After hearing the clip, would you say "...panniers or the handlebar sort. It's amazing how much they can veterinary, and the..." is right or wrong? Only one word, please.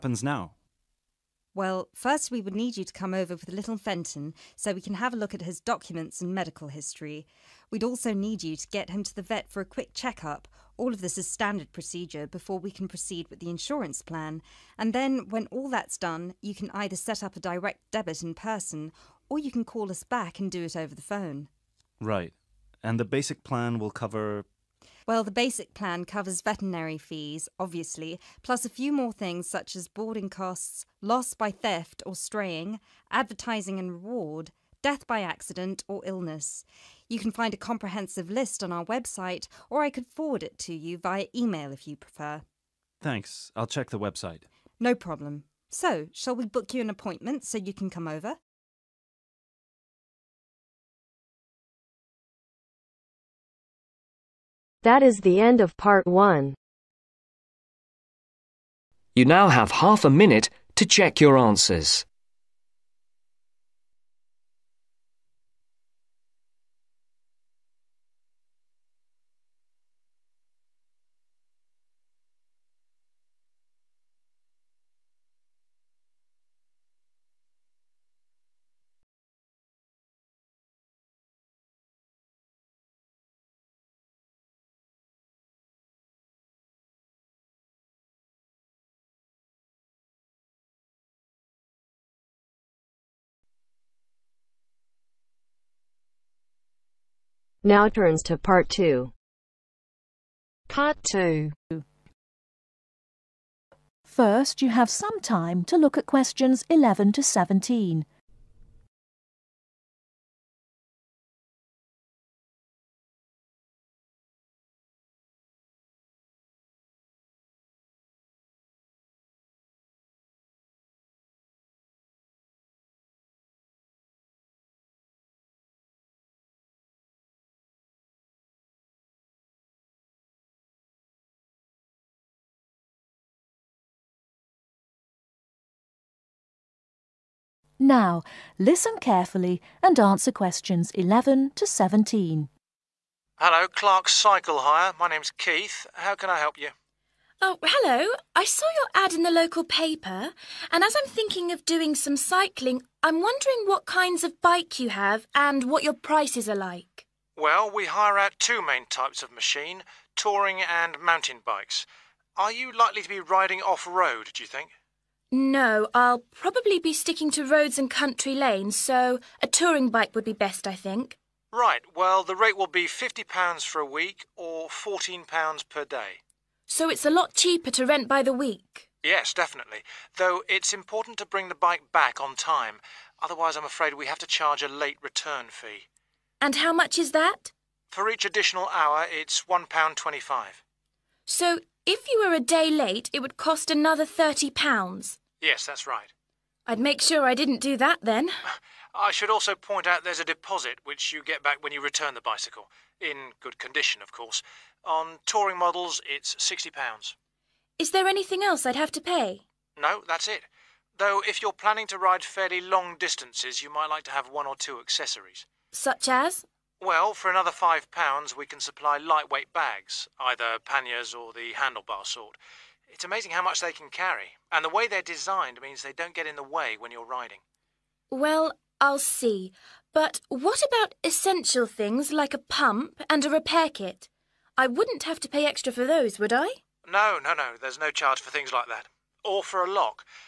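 wrong.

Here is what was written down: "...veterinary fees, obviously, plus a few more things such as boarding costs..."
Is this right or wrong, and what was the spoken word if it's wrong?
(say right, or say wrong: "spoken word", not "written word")
right.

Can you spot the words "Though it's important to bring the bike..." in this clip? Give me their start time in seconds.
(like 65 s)
180 s.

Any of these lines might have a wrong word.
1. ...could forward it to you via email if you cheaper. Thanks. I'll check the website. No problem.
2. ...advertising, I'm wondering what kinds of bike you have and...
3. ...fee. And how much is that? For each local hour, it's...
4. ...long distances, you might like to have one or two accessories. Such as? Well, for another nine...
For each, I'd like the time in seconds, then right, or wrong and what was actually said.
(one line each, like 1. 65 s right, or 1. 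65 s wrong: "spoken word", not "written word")
1. 39 s wrong: "prefer", not "cheaper"
2. 152 s wrong: "cycling", not "advertising"
3. 185 s wrong: "additional", not "local"
4. 212 s wrong: "five", not "nine".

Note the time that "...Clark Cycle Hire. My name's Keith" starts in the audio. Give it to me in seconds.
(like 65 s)
143 s.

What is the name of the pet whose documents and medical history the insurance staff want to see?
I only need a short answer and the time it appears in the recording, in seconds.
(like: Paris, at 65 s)
Fenton, at 3 s.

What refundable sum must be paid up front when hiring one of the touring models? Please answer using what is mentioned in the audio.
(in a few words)
£60.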